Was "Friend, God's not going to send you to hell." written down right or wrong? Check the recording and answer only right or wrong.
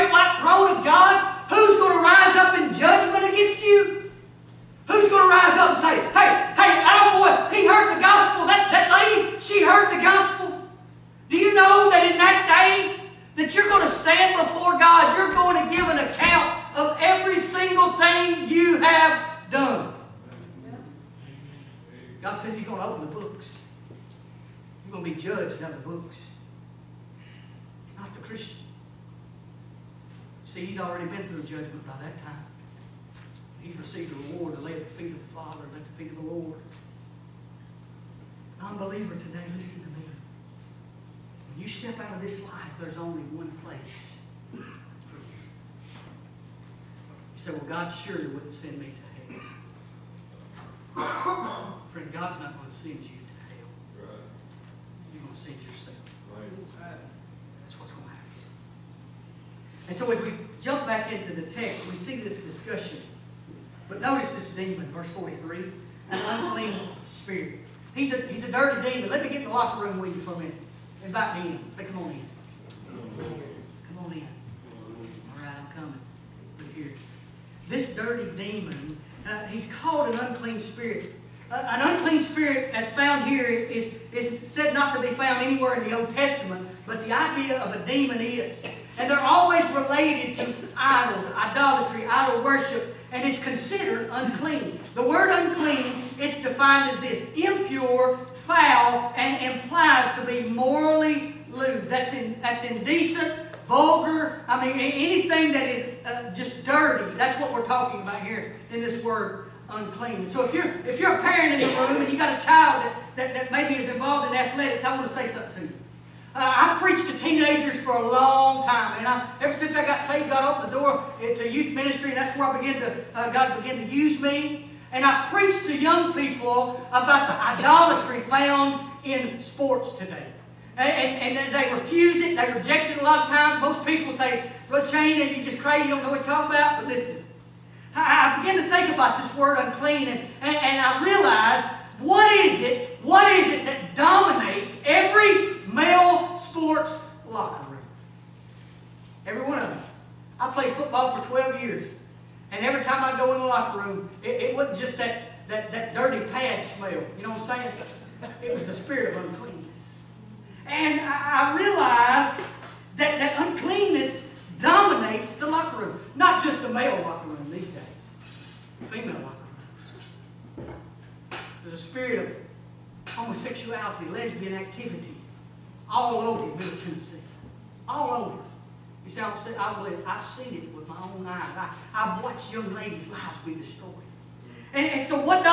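right.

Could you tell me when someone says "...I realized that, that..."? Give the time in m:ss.
2:41.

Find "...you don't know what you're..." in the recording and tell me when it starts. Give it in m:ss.
2:15.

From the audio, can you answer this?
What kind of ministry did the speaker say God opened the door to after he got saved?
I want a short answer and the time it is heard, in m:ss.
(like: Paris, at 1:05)
Youth ministry, at 2:01.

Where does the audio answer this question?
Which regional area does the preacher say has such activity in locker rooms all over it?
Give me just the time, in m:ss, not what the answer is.
2:56.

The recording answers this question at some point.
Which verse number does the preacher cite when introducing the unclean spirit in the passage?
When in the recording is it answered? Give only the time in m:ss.
1:04.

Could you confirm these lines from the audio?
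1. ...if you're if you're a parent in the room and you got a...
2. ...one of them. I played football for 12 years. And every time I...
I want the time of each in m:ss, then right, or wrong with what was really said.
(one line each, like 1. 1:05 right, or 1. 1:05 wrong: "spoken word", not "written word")
1. 1:50 right
2. 2:29 right.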